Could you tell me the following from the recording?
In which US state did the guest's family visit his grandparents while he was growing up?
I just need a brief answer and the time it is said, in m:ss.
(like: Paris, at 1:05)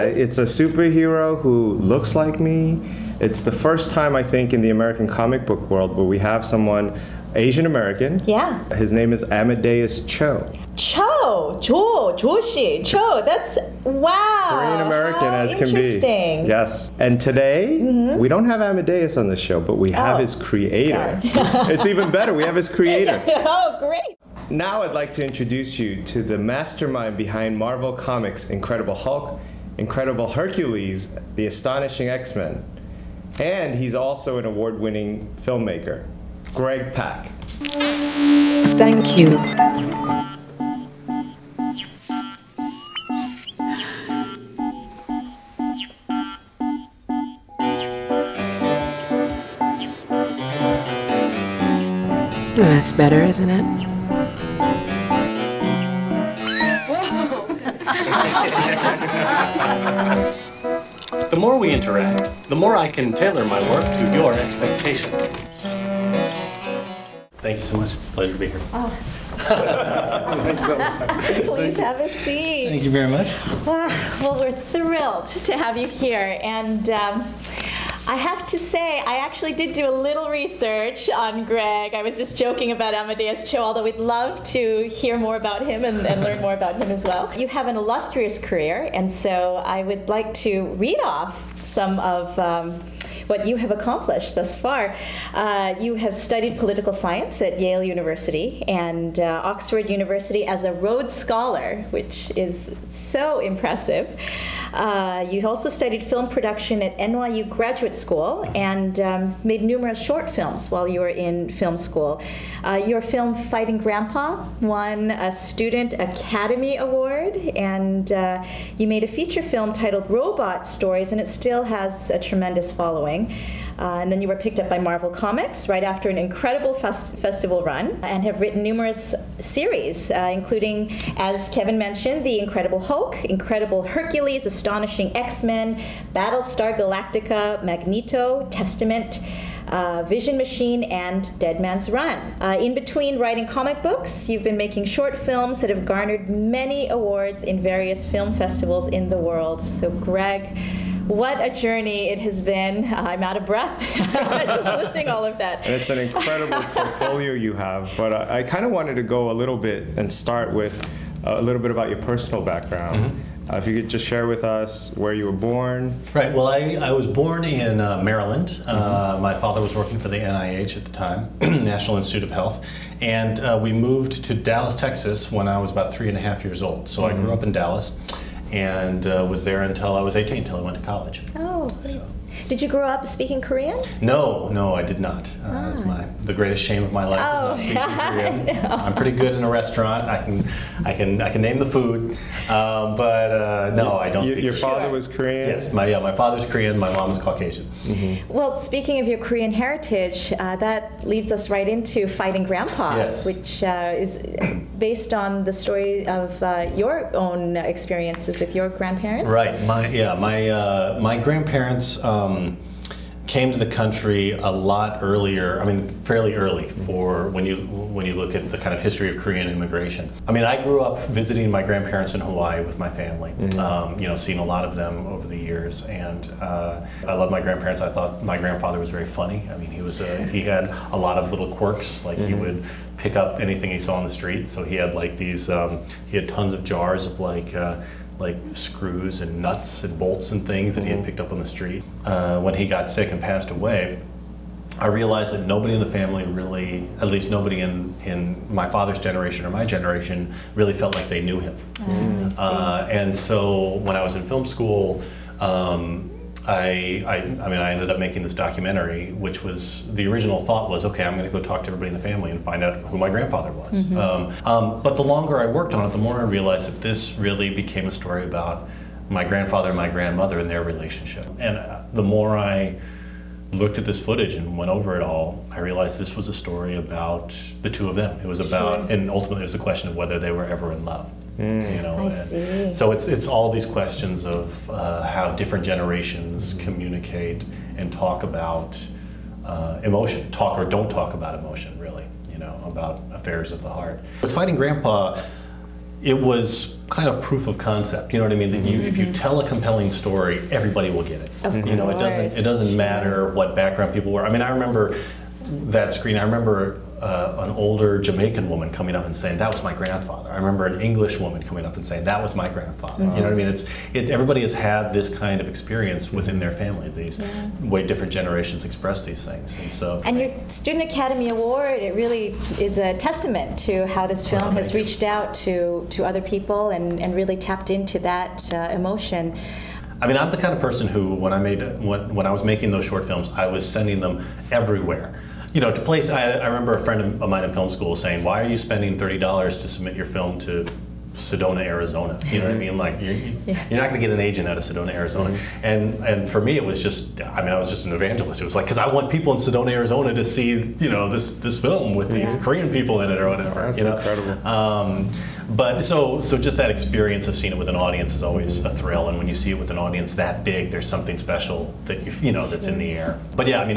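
Hawaii, at 3:42.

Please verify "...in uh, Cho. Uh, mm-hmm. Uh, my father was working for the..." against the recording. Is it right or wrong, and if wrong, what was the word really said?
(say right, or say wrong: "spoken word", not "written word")
wrong: "Maryland", not "Cho".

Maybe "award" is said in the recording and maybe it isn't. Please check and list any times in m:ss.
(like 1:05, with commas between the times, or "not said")
0:34, 1:56, 2:26, 5:21.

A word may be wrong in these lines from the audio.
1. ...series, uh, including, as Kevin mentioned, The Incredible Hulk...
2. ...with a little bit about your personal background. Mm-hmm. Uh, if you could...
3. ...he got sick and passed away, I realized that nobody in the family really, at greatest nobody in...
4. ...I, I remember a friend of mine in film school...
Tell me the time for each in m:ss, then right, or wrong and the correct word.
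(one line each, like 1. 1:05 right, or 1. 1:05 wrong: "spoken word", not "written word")
1. 2:09 right
2. 2:40 right
3. 4:02 wrong: "least", not "greatest"
4. 5:36 right.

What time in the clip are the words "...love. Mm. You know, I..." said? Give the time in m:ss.
4:40.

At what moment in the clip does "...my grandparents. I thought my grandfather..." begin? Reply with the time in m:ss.
3:47.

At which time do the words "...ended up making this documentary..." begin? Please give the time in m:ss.
4:17.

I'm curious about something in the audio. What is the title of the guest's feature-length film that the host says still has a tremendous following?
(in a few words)
Robot Stories.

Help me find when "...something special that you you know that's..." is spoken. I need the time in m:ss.
6:00.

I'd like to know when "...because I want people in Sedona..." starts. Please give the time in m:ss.
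5:48.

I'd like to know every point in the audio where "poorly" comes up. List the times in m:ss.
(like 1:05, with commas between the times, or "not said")
not said.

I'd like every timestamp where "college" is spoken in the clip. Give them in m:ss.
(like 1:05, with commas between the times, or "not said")
3:00.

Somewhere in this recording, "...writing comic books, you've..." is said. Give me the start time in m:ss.
2:23.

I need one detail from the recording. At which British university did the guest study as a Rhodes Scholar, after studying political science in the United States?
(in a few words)
Oxford University.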